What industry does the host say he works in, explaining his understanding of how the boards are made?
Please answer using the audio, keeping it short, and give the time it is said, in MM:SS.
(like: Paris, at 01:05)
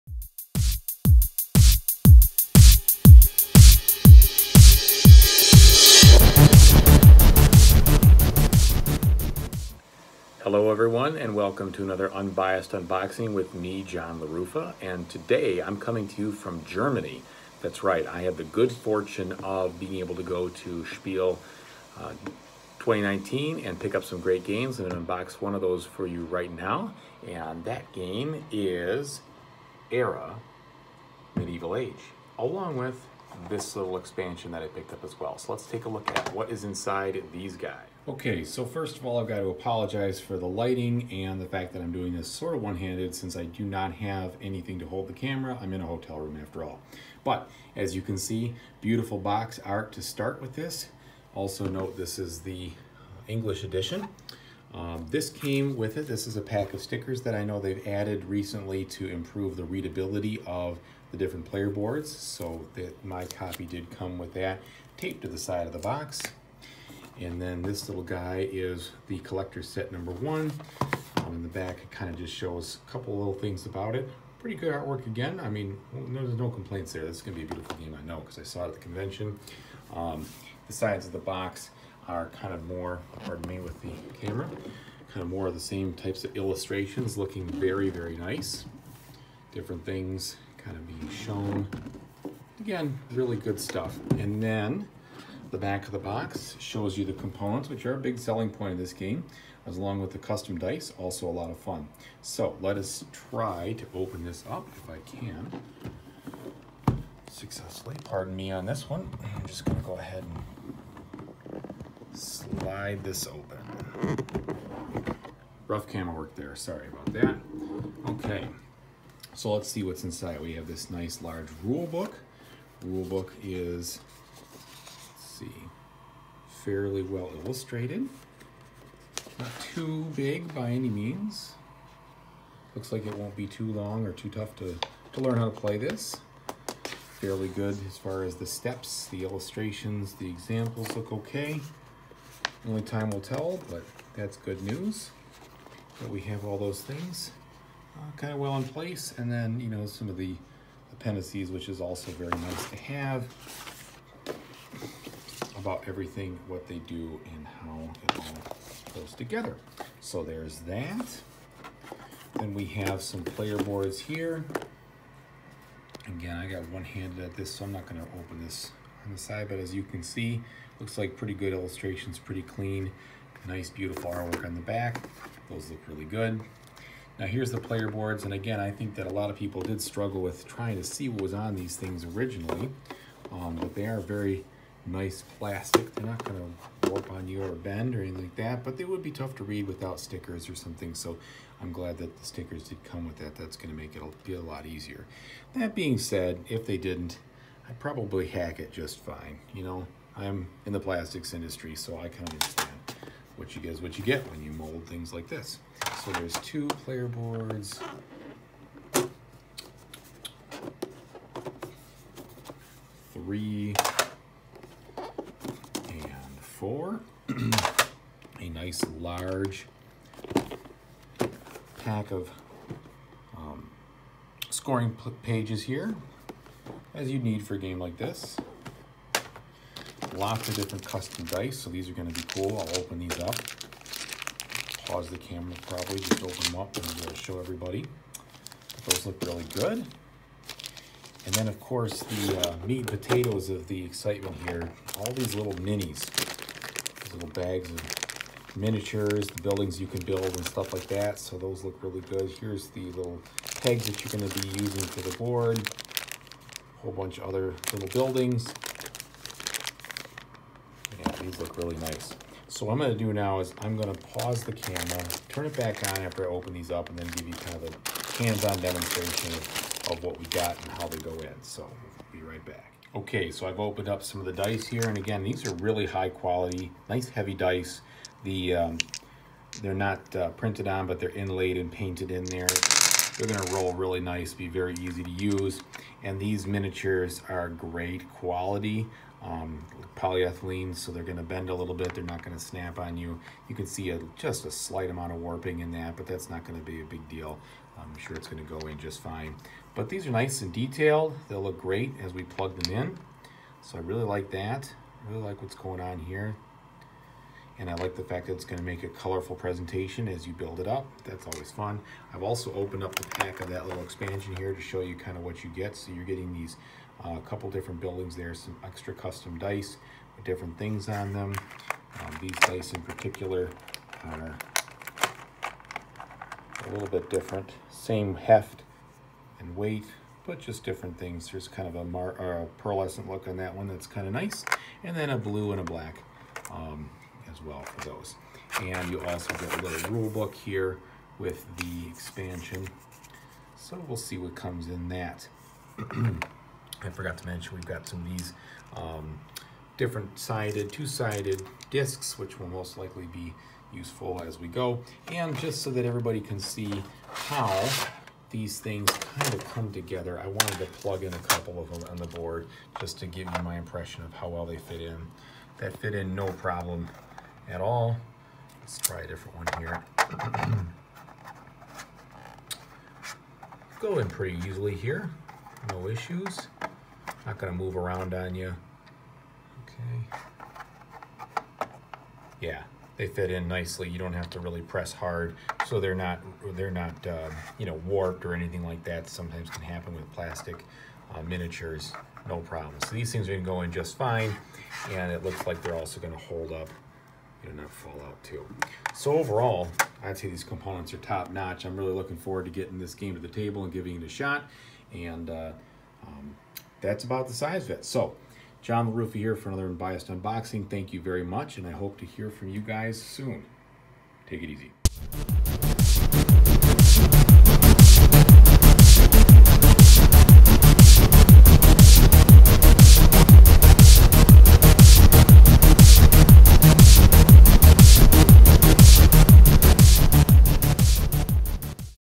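plastics industry, at 03:20.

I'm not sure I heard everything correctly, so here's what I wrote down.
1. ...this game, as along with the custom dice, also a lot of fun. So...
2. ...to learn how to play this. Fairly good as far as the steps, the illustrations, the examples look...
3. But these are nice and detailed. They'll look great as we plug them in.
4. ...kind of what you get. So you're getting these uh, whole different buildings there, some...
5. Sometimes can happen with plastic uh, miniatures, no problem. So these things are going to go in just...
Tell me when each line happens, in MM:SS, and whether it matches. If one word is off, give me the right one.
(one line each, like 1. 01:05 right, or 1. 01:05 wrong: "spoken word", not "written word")
1. 01:38 right
2. 02:15 right
3. 04:59 right
4. 05:14 wrong: "couple", not "whole"
5. 06:29 right.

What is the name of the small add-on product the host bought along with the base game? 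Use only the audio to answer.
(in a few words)
collector set number one.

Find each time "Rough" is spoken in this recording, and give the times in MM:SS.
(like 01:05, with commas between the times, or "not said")
01:55.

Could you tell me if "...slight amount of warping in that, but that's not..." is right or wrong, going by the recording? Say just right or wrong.
right.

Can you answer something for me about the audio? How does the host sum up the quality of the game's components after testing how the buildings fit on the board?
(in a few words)
top notch.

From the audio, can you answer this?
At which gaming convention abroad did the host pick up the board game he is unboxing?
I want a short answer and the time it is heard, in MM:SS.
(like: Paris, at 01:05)
Spiel 2019, at 00:20.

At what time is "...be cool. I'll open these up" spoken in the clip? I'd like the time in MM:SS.
03:52.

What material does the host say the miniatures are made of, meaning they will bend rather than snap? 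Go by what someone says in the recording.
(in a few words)
polyethylene.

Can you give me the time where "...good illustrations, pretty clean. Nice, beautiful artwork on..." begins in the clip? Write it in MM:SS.
02:51.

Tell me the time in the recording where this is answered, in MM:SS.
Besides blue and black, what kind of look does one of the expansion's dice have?
05:32.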